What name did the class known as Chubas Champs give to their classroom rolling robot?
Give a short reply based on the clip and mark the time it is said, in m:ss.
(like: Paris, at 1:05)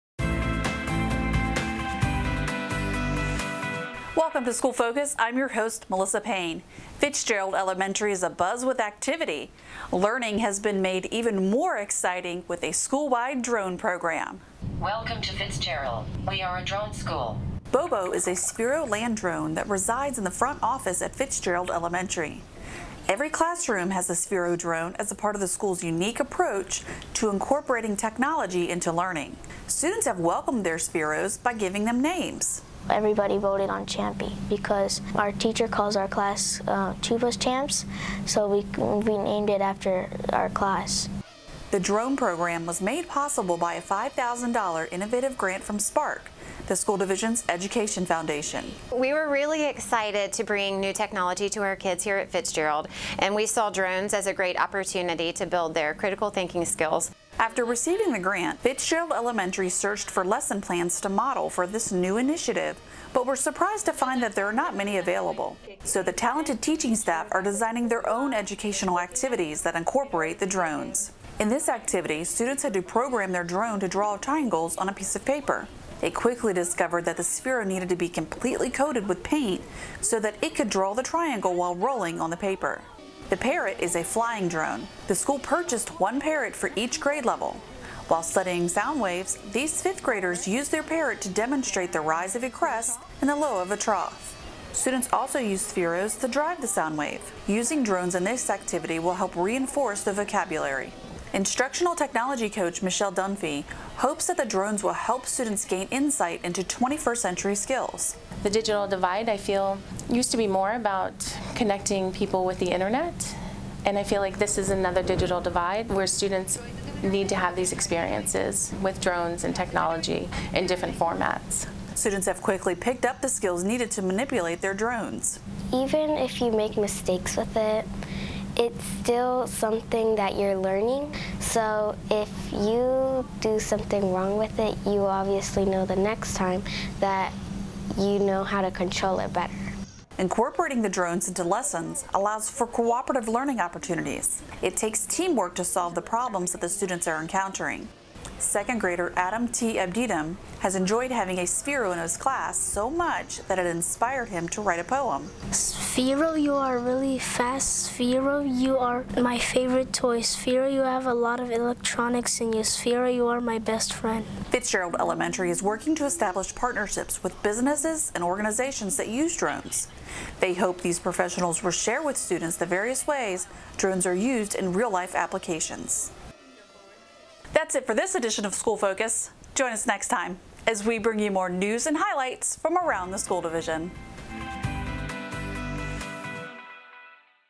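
Champy, at 0:33.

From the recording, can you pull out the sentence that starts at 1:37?
Using drones in this activity will help reinforce the vocabulary.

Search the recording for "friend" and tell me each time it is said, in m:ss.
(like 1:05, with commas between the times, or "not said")
2:43.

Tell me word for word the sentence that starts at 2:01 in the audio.
Students have quickly picked up the skills needed to manipulate their drones.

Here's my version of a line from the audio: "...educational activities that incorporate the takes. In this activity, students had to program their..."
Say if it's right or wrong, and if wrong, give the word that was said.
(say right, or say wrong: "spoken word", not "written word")
wrong: "drones", not "takes".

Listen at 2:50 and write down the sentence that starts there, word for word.
They hope these professionals will share with students the various ways drones are used in real-life applications.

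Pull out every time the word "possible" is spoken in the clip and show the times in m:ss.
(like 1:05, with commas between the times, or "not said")
0:43.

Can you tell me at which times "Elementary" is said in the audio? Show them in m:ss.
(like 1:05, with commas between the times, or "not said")
0:07, 0:21, 0:59, 2:44.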